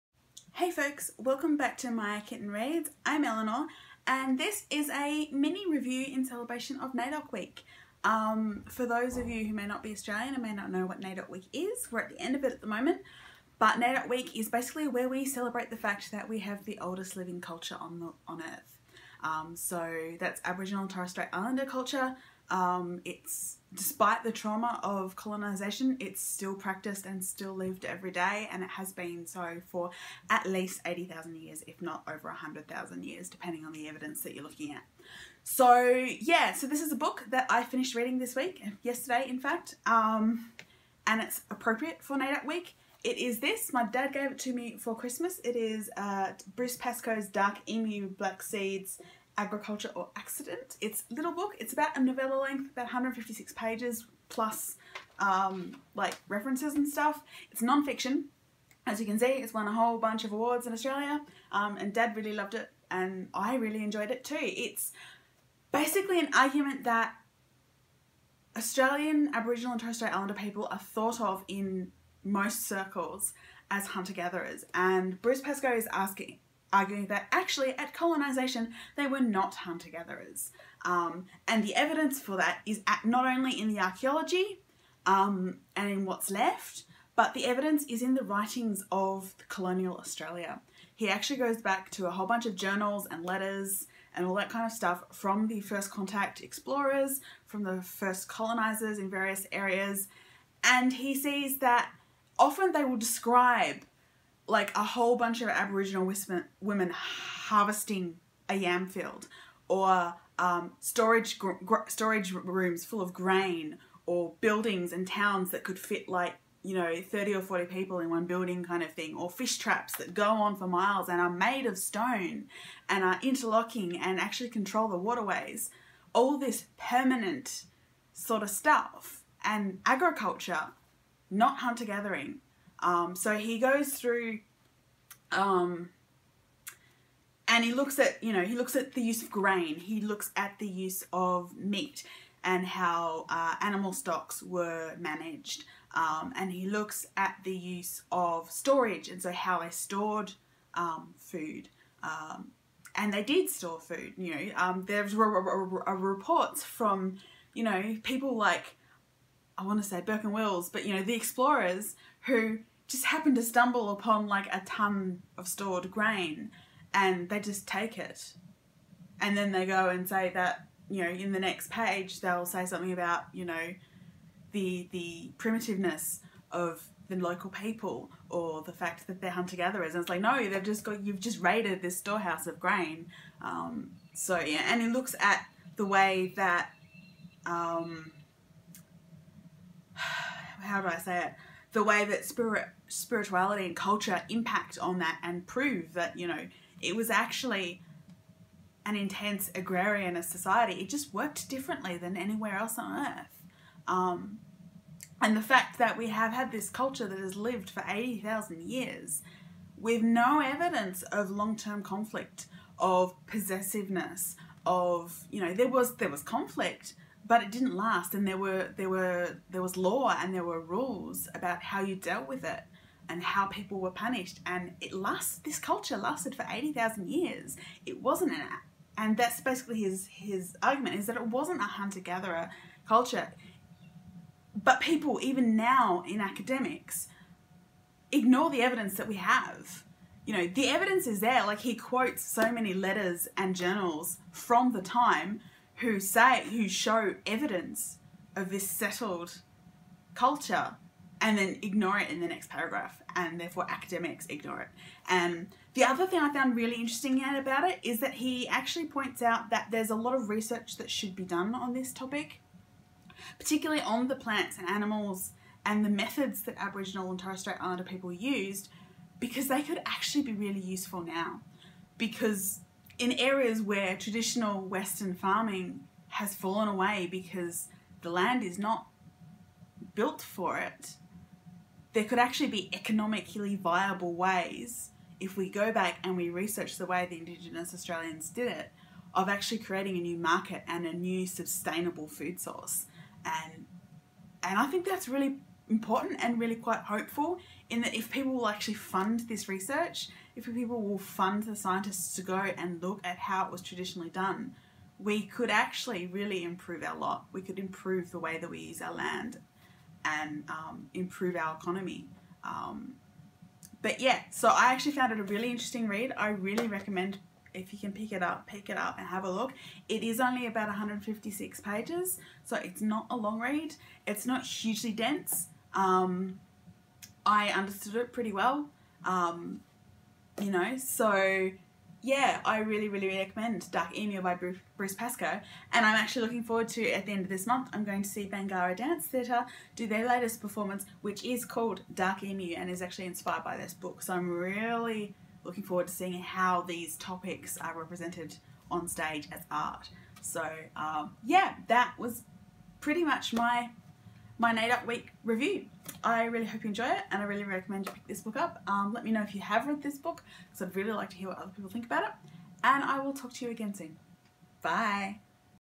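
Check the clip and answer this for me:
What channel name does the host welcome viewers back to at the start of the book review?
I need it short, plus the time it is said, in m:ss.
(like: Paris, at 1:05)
Maya Kitten Reads, at 0:01.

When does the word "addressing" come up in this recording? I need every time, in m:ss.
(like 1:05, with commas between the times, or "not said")
not said.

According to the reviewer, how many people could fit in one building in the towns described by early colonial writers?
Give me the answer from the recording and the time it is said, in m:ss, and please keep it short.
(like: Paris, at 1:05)
30 or 40, at 1:57.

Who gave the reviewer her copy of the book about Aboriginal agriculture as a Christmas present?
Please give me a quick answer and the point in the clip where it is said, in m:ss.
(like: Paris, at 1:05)
My dad, at 0:43.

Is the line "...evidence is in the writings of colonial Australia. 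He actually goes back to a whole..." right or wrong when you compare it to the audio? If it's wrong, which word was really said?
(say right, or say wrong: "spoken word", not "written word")
right.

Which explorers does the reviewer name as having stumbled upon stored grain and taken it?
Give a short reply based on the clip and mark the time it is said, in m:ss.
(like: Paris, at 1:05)
Burke and Wills, at 2:40.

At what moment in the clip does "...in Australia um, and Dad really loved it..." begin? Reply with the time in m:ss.
1:00.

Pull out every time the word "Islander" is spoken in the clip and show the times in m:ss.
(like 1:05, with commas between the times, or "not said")
0:21, 1:10, 4:27.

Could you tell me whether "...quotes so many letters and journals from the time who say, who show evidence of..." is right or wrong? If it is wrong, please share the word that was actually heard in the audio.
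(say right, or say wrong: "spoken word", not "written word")
right.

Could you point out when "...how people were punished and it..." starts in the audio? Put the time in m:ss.
3:43.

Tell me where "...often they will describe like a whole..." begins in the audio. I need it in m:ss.
1:42.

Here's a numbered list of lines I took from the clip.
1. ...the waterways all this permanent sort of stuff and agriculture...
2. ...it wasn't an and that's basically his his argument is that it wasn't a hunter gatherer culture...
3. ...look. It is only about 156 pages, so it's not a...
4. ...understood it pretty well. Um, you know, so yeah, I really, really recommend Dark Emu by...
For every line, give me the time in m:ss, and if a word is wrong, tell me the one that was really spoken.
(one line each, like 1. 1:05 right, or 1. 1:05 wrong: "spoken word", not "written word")
1. 2:04 right
2. 3:47 right
3. 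5:19 right
4. 5:27 right.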